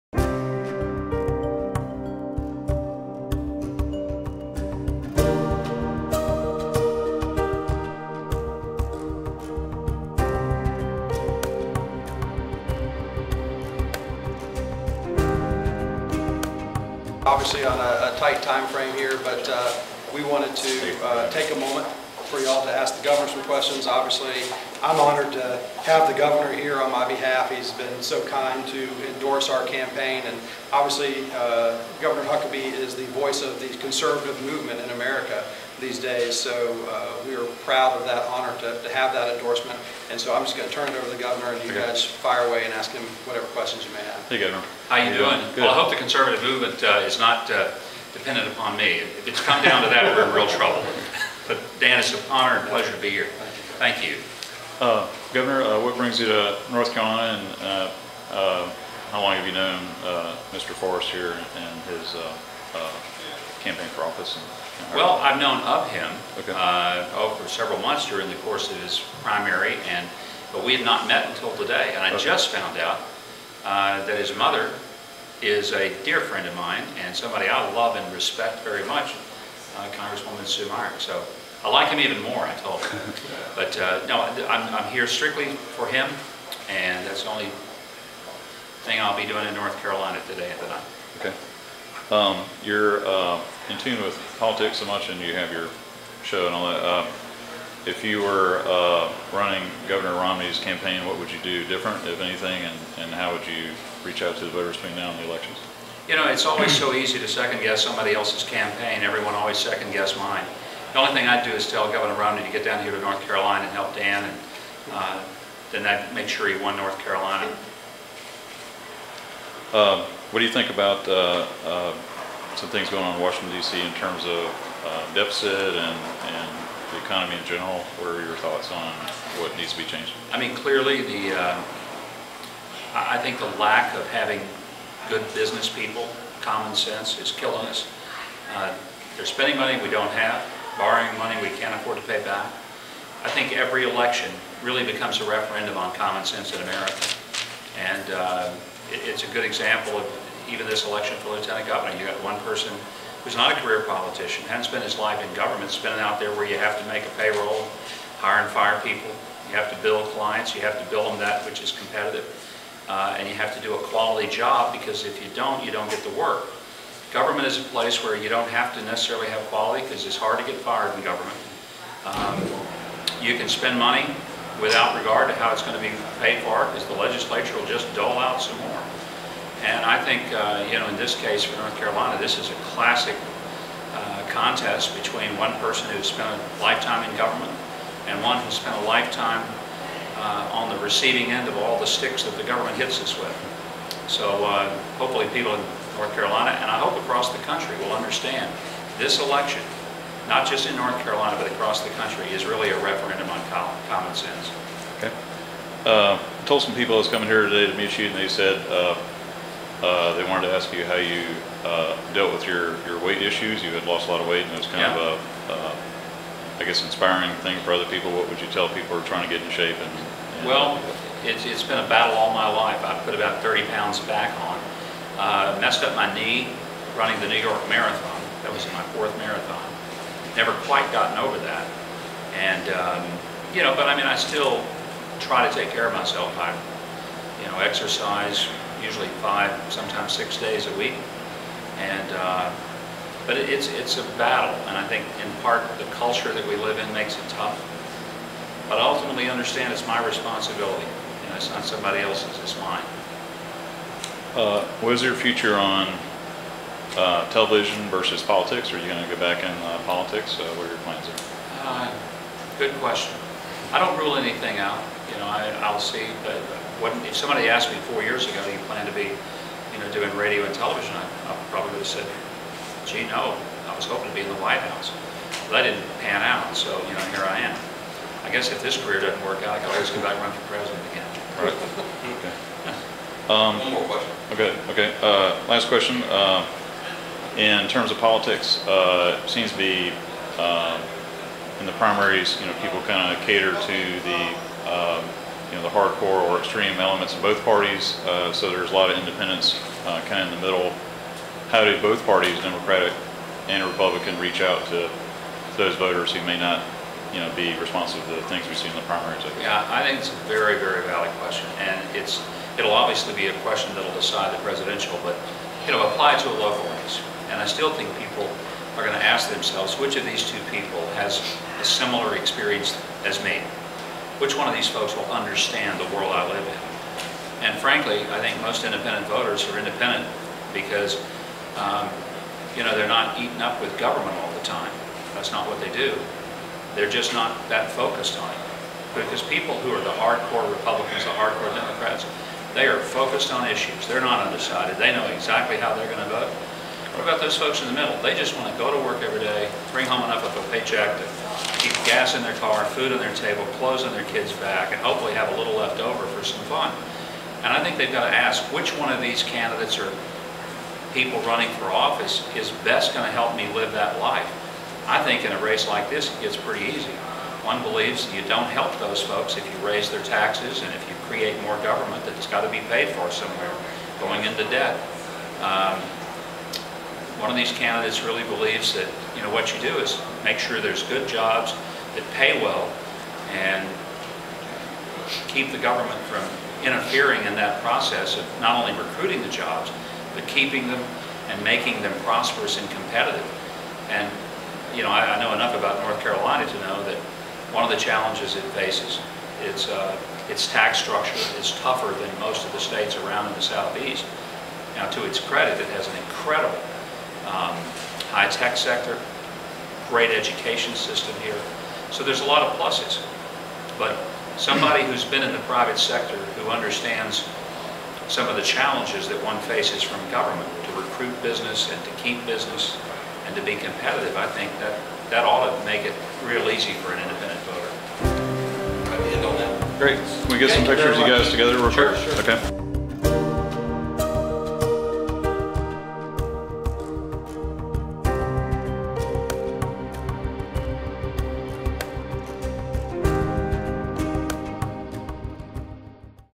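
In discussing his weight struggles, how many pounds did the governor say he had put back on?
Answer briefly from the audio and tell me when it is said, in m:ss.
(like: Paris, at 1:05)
30, at 3:43.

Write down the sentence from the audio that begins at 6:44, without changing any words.
Now, to its credit, it has an incredible um, high-tech sector, great education system here.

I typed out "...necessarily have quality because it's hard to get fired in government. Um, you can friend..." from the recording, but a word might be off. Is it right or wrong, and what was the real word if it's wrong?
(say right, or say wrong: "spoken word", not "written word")
wrong: "spend", not "friend".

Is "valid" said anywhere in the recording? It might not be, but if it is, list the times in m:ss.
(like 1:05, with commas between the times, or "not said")
5:10.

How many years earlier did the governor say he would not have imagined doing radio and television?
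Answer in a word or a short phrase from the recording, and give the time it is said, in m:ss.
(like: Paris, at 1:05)
4, at 4:27.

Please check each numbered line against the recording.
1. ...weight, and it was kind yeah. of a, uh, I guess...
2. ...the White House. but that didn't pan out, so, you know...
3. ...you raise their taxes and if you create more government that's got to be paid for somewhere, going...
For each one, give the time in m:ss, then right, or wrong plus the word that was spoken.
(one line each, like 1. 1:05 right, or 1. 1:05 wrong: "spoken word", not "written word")
1. 3:34 right
2. 4:34 right
3. 6:09 right.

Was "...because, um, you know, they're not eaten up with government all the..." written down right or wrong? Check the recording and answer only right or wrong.
right.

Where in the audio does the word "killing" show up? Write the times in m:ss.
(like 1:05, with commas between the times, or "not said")
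2:17.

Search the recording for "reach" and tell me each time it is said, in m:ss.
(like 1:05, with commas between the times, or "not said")
1:44, 5:04.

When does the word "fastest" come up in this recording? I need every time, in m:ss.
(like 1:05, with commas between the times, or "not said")
not said.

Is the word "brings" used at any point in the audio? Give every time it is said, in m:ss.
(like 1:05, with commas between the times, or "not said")
0:55, 5:49.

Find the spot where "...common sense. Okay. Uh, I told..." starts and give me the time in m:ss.
3:23.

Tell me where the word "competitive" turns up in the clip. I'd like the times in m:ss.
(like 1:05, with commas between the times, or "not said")
2:41, 6:32, 7:03.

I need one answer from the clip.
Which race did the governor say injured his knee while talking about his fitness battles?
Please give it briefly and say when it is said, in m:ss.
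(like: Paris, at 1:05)
New York Marathon, at 3:47.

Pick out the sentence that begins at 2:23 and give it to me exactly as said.
I think every election really becomes a referendum on common sense in America.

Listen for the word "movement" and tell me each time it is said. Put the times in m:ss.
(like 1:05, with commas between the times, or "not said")
0:34, 0:46.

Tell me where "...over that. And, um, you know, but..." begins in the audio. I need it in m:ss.
3:51.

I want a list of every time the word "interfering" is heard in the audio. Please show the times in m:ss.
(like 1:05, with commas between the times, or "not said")
6:26.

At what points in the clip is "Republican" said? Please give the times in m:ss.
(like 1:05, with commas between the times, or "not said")
5:03, 5:40.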